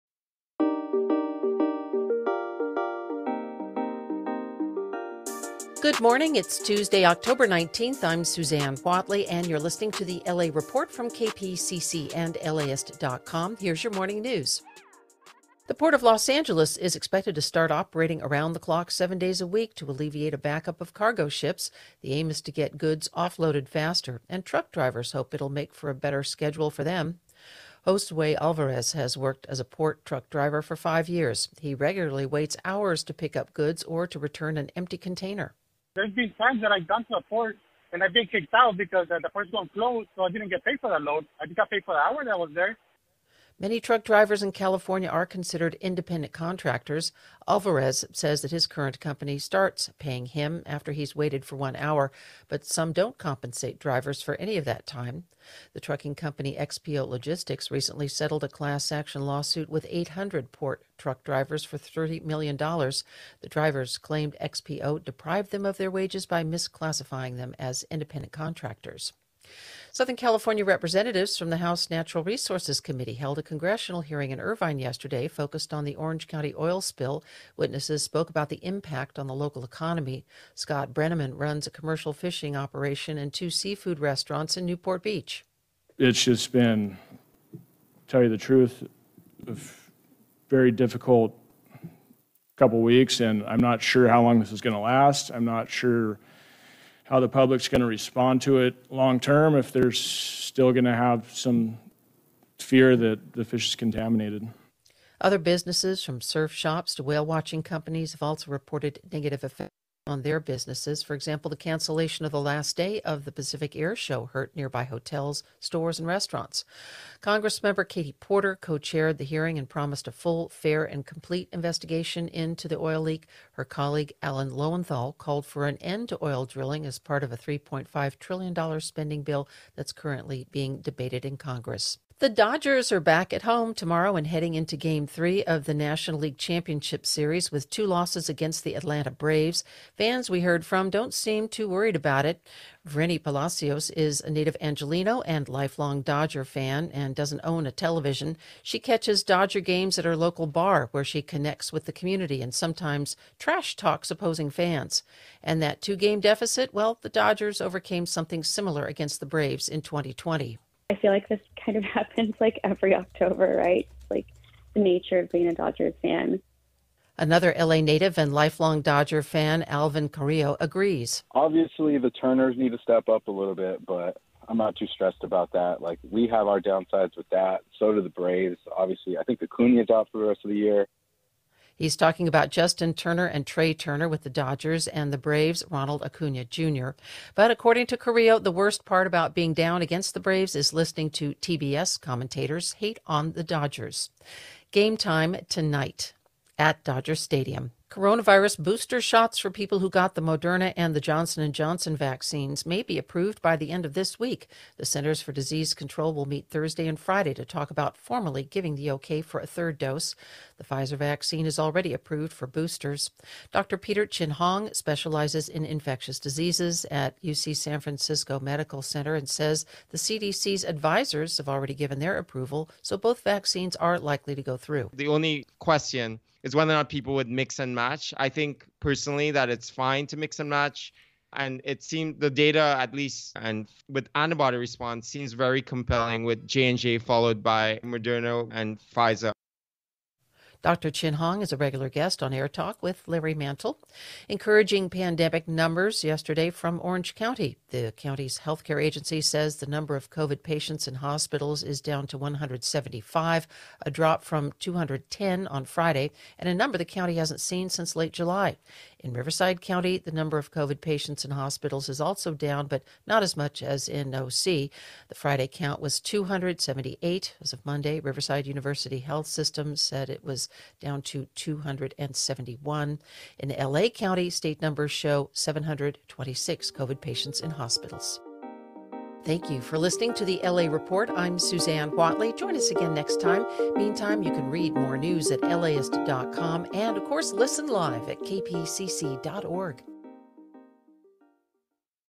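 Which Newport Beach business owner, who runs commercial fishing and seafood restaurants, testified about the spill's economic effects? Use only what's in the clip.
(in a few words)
Scott Brenneman.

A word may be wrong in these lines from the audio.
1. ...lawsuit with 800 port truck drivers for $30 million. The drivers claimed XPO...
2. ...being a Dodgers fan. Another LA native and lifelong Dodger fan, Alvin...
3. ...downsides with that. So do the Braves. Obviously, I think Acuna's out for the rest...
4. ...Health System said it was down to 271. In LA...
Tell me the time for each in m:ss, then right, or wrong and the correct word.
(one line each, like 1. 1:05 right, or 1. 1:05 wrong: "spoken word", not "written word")
1. 0:59 right
2. 2:45 right
3. 2:56 right
4. 4:28 right.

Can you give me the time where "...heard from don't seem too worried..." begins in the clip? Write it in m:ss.
2:20.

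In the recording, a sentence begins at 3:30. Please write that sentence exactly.
The Pfizer vaccine is already approved for boosters.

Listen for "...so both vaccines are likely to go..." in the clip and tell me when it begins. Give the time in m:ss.
3:42.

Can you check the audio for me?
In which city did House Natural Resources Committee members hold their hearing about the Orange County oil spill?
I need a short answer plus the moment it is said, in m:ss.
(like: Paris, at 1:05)
Irvine, at 1:14.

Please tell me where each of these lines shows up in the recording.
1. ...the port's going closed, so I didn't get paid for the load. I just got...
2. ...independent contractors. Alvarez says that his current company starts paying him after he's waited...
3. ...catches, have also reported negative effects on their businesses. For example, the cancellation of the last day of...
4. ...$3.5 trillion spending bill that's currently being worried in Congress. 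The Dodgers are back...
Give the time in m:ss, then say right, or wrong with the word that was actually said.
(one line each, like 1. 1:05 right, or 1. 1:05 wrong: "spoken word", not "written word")
1. 0:39 right
2. 0:45 right
3. 1:47 wrong: "companies", not "catches"
4. 2:07 wrong: "debated", not "worried".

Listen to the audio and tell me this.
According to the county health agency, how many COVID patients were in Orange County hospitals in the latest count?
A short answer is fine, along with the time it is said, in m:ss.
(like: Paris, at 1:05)
175, at 4:12.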